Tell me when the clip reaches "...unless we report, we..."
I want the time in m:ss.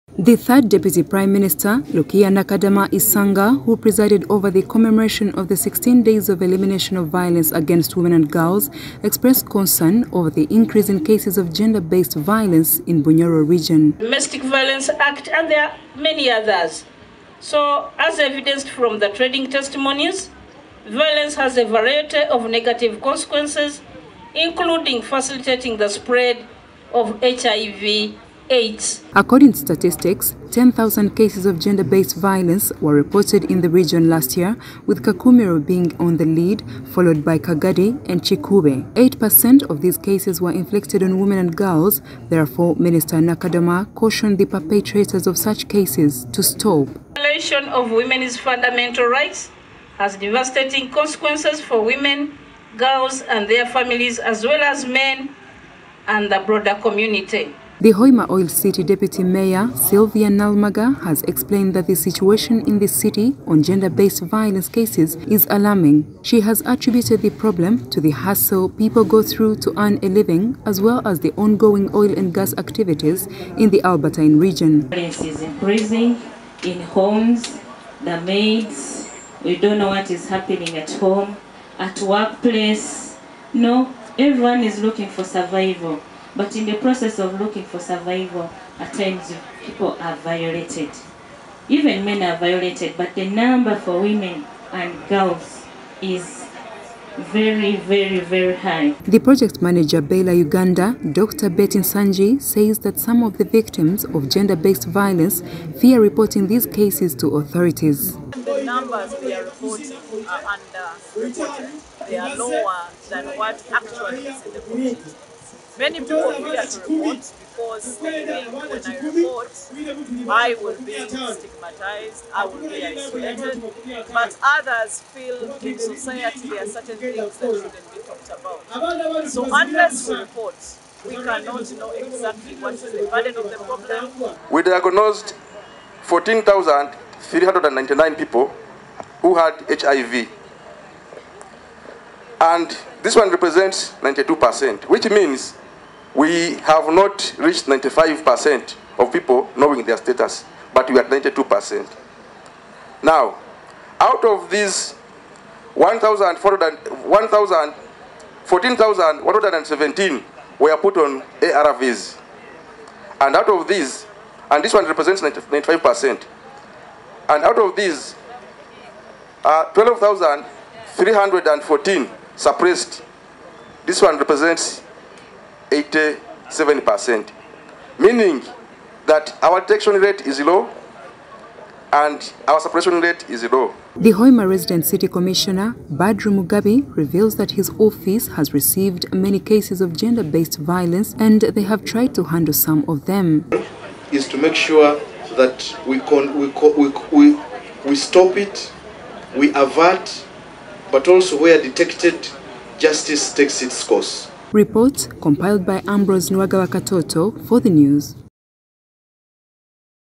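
2:09.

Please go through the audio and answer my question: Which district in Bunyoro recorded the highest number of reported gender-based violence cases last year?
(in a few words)
Kakumiro.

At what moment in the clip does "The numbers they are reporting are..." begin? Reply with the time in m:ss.
1:48.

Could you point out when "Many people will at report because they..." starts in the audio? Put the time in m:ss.
1:55.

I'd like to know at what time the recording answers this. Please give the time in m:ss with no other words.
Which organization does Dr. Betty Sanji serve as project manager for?
1:40.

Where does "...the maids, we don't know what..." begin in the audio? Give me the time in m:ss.
1:18.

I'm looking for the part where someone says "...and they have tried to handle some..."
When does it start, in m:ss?
3:11.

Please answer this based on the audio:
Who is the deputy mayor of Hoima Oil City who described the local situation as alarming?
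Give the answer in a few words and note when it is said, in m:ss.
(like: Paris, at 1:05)
Sylvia Nalmaga, at 0:59.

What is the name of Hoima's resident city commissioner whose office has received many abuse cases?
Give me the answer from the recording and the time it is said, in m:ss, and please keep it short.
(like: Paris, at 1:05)
Badru Mugabe, at 3:05.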